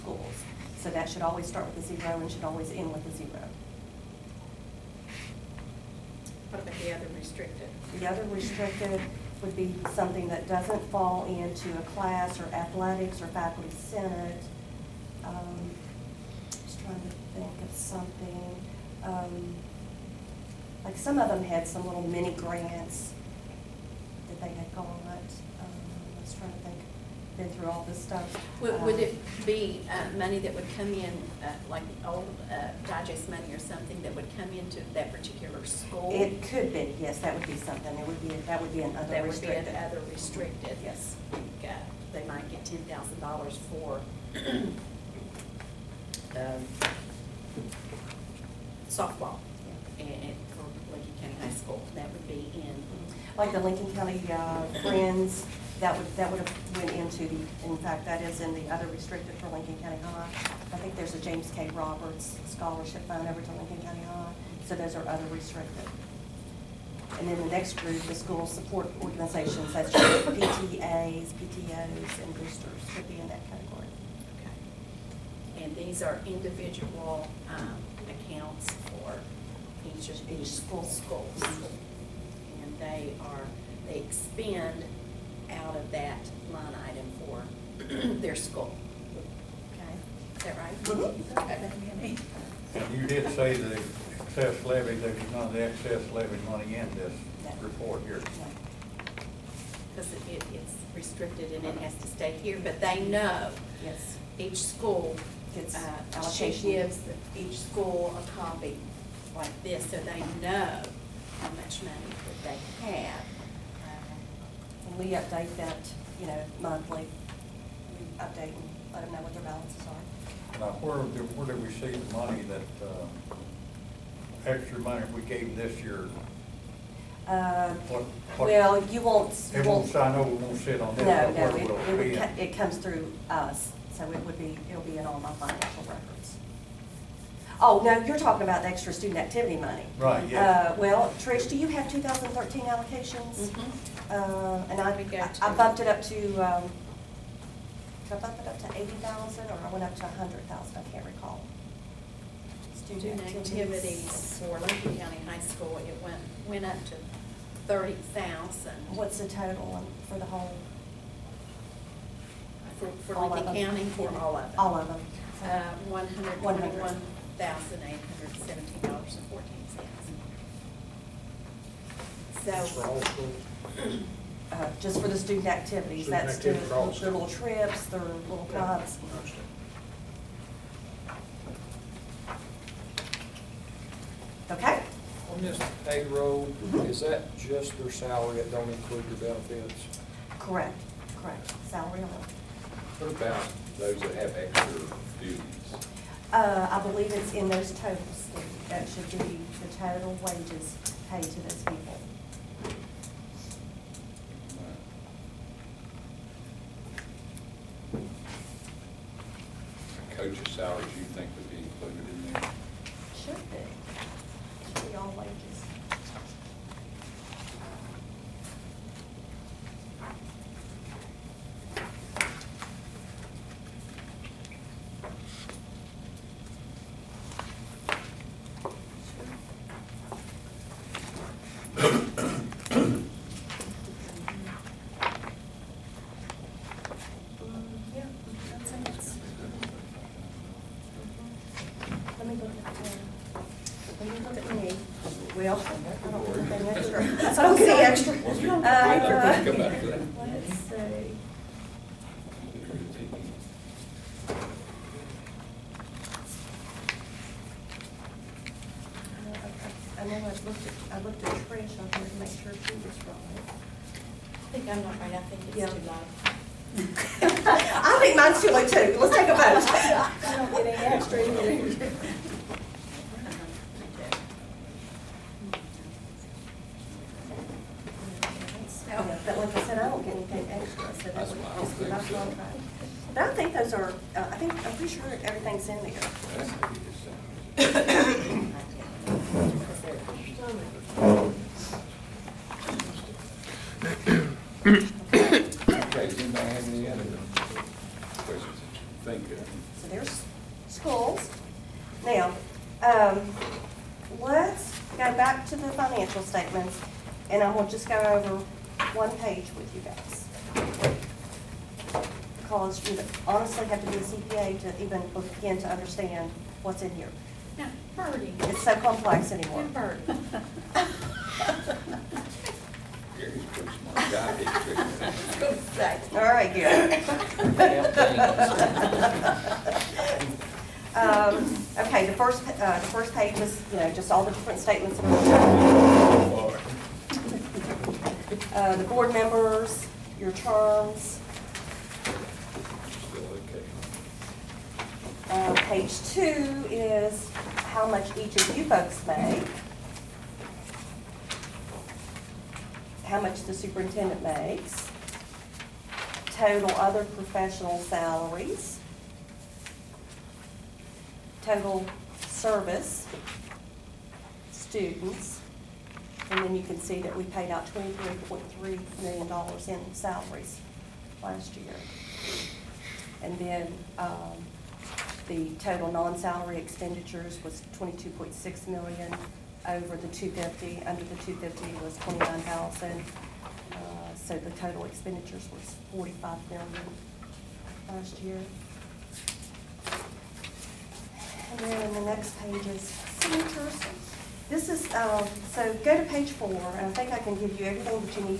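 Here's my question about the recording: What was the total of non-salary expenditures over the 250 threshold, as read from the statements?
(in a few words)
22.6 million.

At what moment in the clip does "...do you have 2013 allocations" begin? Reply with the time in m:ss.
2:21.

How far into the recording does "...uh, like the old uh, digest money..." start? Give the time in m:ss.
0:31.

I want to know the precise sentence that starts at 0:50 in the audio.
and, and for Lincoln County High School.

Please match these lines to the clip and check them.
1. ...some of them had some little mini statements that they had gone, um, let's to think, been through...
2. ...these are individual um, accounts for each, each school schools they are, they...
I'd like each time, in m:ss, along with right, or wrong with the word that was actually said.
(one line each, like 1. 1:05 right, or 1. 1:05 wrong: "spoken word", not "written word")
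1. 0:20 wrong: "grants", not "statements"
2. 1:15 right.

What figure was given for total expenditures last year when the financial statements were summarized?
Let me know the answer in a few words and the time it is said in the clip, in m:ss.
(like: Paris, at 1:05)
45 million, at 6:25.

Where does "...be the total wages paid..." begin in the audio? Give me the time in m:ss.
3:19.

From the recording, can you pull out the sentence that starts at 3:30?
Coach's salaries you think would be included in there?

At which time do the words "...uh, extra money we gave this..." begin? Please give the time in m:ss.
2:02.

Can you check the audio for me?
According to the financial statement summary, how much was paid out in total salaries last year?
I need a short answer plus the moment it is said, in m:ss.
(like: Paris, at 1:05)
$23.3 million, at 6:07.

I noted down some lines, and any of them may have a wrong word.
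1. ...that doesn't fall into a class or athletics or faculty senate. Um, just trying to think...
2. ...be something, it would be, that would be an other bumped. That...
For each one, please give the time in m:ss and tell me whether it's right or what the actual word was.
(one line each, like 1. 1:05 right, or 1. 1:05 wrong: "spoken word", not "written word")
1. 0:10 right
2. 0:37 wrong: "restricted", not "bumped".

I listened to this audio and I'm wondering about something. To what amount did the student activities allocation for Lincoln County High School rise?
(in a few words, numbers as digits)
30,000.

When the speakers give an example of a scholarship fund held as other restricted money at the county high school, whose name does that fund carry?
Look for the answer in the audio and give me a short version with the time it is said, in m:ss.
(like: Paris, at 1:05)
James K. Roberts, at 1:01.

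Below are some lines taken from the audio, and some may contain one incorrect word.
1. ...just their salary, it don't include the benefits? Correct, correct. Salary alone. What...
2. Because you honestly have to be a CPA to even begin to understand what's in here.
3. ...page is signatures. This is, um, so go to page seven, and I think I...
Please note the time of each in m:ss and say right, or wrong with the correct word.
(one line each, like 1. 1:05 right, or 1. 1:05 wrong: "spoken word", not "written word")
1. 3:07 right
2. 5:12 right
3. 6:32 wrong: "four", not "seven".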